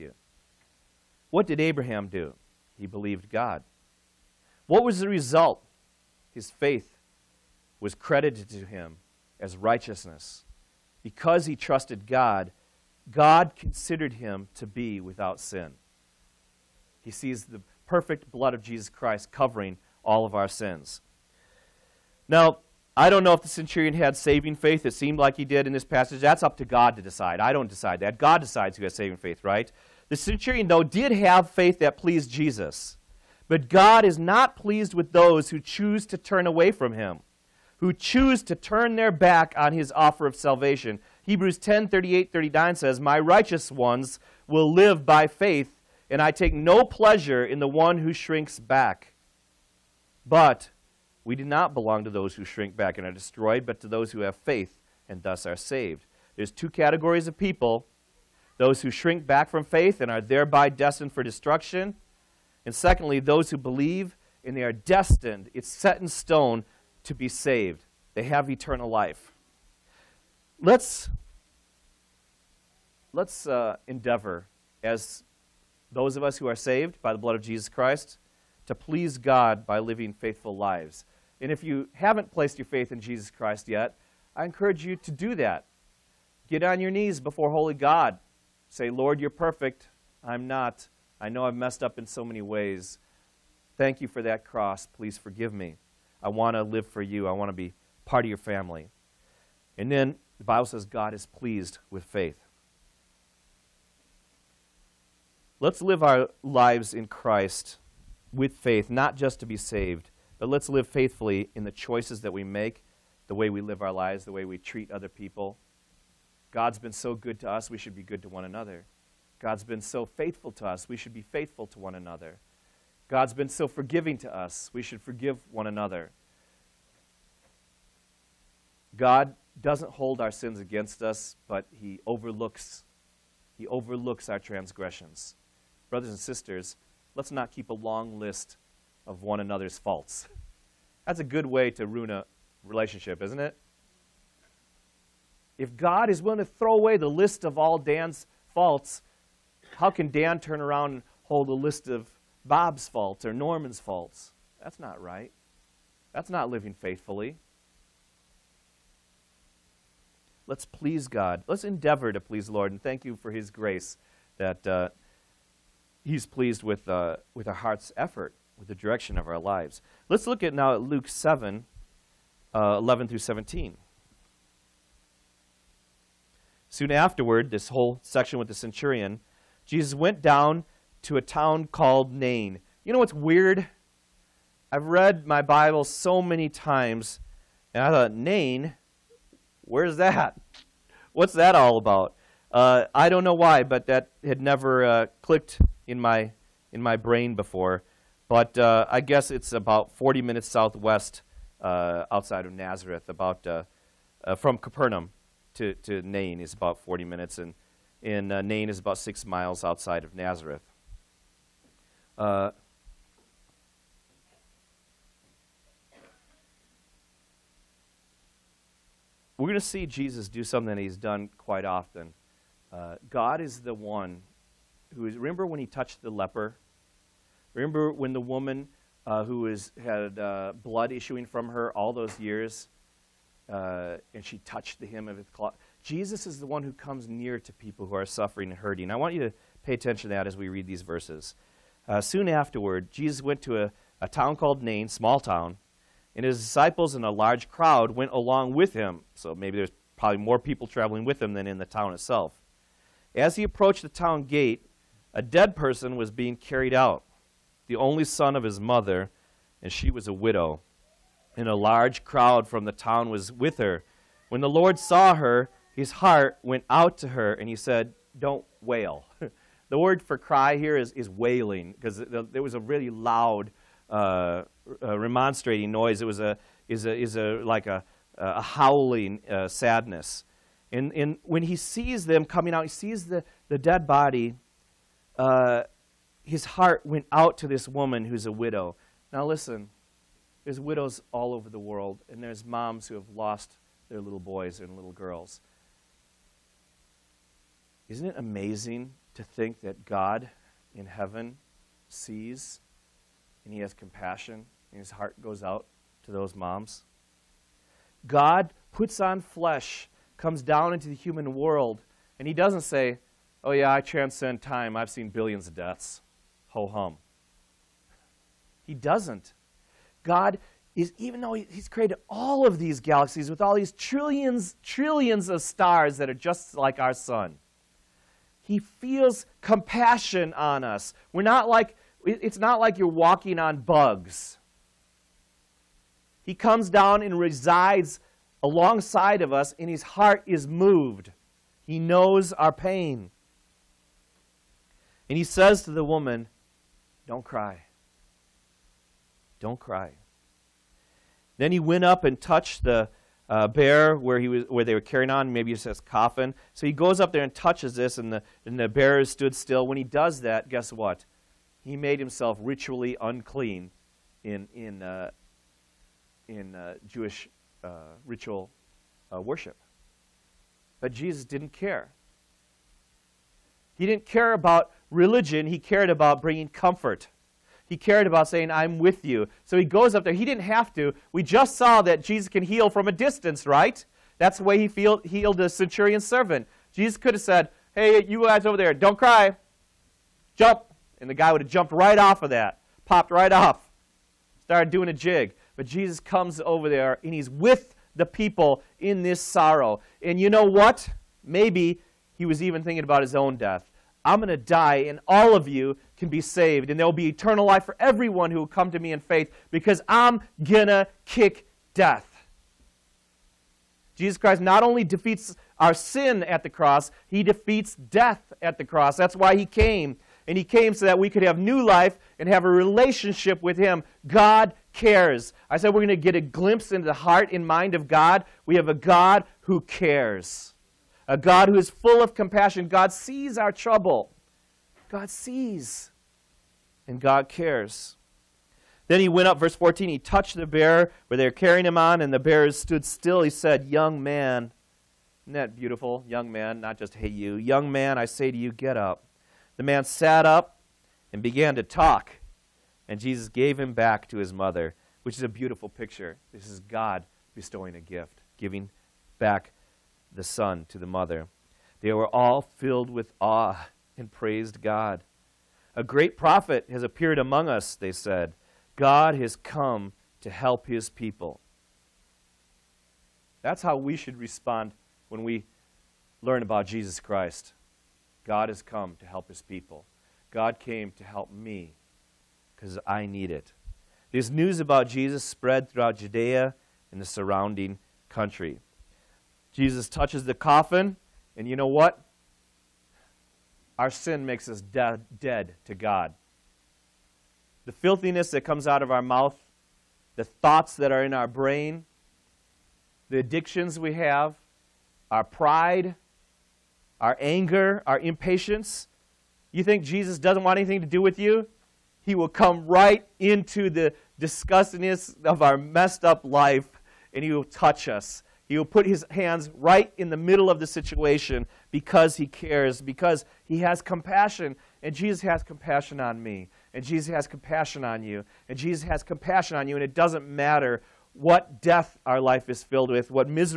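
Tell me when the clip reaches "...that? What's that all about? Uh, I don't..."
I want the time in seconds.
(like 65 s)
189 s.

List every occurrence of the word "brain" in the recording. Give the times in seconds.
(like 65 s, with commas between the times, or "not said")
196 s, 501 s.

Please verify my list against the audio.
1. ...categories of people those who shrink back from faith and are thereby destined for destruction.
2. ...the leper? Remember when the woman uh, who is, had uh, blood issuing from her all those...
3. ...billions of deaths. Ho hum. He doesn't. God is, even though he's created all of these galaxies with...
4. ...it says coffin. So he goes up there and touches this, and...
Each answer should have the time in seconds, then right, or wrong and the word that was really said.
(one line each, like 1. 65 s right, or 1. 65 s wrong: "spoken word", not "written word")
1. 56 s right
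2. 226 s right
3. 315 s right
4. 355 s right.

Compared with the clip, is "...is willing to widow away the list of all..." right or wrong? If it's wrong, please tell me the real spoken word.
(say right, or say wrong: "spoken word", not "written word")
wrong: "throw", not "widow".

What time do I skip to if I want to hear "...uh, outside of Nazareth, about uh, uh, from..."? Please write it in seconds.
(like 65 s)
201 s.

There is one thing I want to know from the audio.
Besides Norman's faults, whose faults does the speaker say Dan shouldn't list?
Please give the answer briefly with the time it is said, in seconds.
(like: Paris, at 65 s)
Bob, at 152 s.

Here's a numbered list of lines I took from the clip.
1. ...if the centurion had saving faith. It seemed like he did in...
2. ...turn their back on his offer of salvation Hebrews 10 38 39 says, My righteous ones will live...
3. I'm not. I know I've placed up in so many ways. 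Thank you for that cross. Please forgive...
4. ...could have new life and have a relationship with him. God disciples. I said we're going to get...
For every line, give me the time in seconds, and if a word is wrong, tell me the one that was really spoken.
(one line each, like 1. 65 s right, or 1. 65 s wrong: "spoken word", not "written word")
1. 23 s right
2. 38 s right
3. 90 s wrong: "messed", not "placed"
4. 421 s wrong: "cares", not "disciples".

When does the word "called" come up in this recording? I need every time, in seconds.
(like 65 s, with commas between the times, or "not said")
181 s, 244 s.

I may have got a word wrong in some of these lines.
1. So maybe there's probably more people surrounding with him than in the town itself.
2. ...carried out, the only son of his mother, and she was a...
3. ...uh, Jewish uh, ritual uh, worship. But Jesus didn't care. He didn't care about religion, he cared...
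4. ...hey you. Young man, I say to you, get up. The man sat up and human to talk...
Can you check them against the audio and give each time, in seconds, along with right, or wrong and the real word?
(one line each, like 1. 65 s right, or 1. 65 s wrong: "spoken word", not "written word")
1. 249 s wrong: "traveling", not "surrounding"
2. 256 s right
3. 366 s right
4. 446 s wrong: "began", not "human".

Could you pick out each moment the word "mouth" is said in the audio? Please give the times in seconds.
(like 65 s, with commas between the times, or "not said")
499 s.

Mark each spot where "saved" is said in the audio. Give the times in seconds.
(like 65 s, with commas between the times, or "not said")
55 s, 67 s, 76 s, 109 s, 406 s.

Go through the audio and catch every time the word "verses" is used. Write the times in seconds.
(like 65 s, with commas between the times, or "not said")
240 s, 439 s.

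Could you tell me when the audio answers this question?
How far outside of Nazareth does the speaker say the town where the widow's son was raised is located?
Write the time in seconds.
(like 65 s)
208 s.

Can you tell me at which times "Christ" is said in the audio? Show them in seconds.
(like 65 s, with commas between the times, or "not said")
18 s, 77 s, 83 s, 107 s, 414 s, 476 s.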